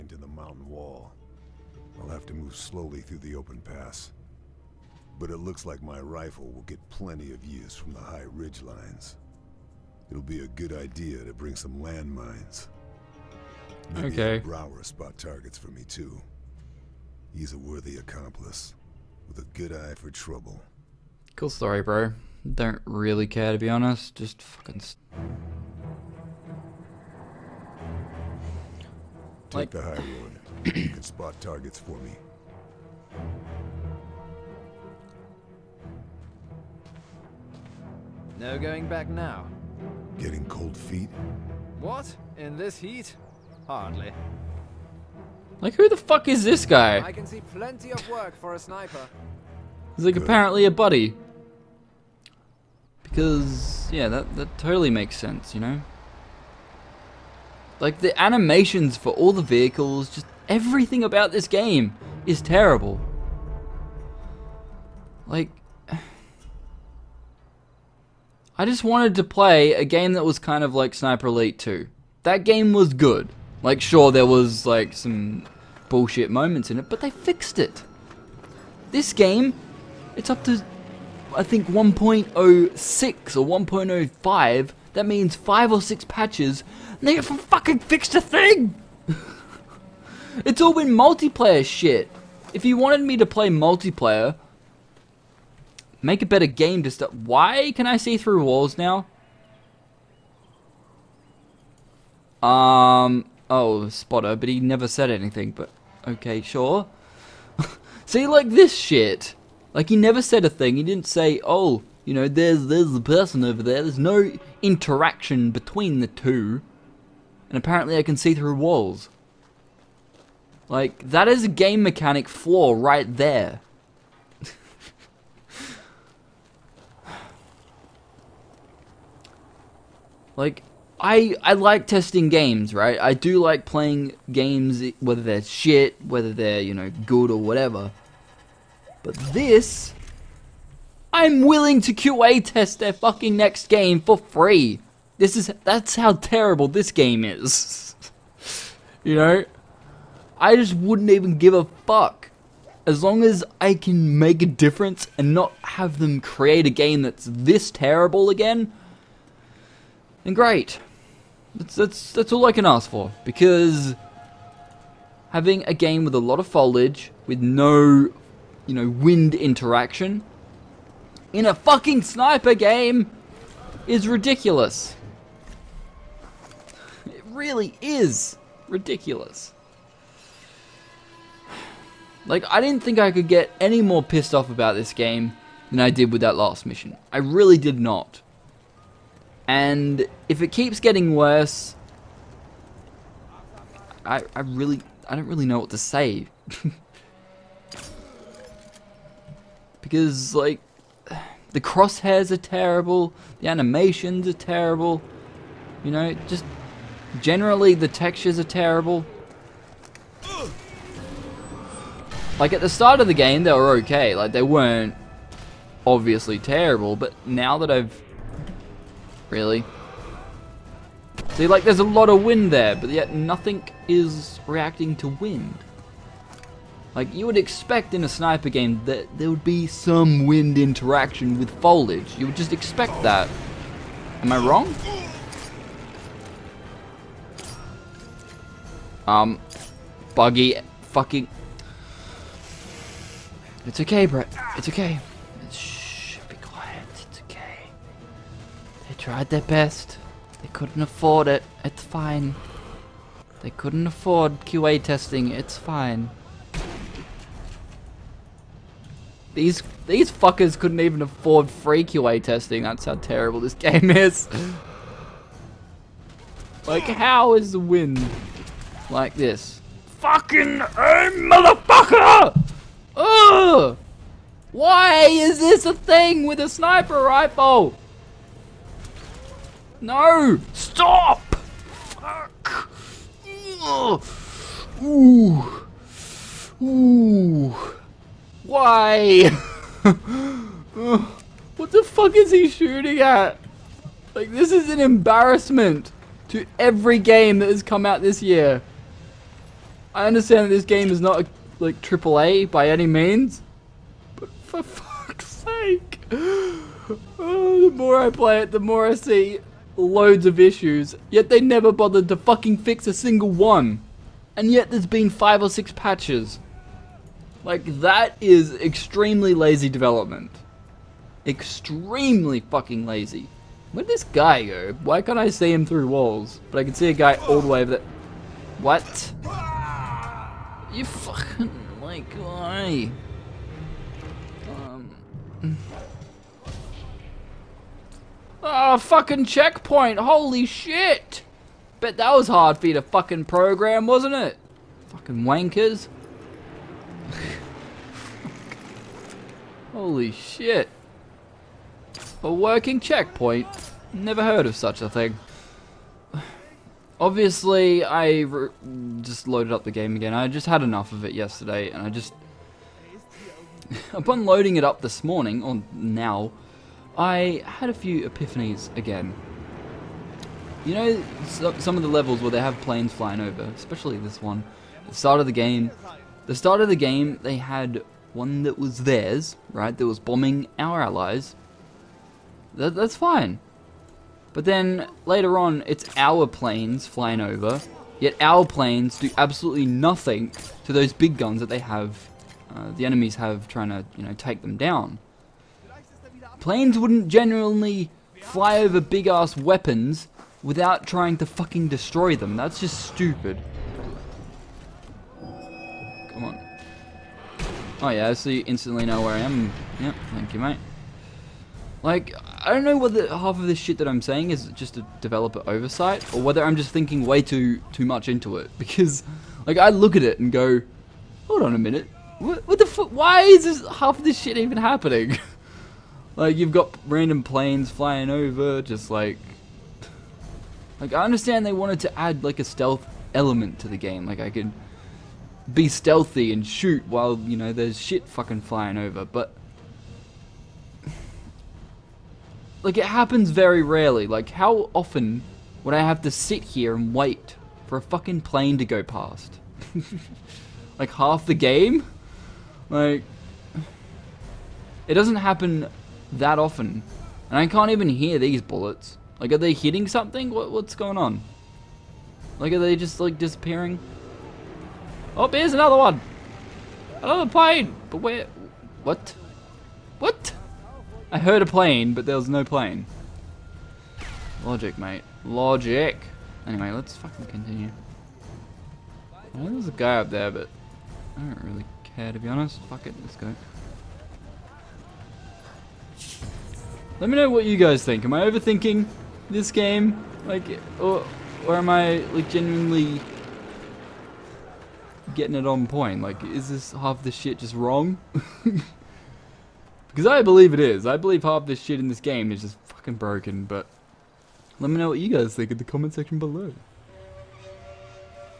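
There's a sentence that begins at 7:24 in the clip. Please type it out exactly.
Like how often would I have to sit here and wait for a fucking plane to go past?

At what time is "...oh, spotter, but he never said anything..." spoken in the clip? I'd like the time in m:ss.
1:43.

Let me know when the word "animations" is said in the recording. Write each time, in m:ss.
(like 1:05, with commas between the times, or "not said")
0:58, 3:23.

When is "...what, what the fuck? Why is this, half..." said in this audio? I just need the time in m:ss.
7:02.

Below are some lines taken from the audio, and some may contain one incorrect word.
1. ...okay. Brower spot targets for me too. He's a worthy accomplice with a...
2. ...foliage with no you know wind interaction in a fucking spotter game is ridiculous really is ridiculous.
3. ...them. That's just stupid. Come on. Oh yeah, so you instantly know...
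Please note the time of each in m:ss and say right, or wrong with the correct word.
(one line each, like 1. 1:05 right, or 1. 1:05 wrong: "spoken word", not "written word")
1. 0:14 right
2. 2:46 wrong: "sniper", not "spotter"
3. 6:42 right.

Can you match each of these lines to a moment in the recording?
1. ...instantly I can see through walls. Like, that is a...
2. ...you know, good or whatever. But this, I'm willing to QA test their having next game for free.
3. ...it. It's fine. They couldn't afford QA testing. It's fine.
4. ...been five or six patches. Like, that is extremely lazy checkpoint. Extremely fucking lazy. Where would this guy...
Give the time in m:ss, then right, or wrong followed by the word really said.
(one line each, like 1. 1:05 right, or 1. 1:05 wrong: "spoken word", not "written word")
1. 1:57 wrong: "apparently", not "instantly"
2. 2:16 wrong: "fucking", not "having"
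3. 4:11 right
4. 5:14 wrong: "development", not "checkpoint".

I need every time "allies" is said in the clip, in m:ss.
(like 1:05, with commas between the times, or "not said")
6:20.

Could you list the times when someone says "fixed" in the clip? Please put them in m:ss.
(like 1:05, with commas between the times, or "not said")
1:17, 1:27.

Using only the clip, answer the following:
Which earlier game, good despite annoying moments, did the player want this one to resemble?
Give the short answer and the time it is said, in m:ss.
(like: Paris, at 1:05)
Sniper Elite 2, at 1:10.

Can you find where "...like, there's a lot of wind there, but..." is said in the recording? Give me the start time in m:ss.
3:41.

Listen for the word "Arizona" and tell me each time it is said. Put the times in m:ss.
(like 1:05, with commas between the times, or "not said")
not said.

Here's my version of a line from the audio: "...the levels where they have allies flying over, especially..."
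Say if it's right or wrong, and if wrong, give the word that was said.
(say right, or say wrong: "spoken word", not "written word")
wrong: "planes", not "allies".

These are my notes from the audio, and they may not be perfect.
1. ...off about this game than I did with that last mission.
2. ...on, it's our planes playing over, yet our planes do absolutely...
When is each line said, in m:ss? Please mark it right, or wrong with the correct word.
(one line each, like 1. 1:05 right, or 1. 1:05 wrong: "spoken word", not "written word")
1. 3:04 right
2. 6:25 wrong: "flying", not "playing".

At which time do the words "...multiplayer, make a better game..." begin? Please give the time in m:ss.
1:33.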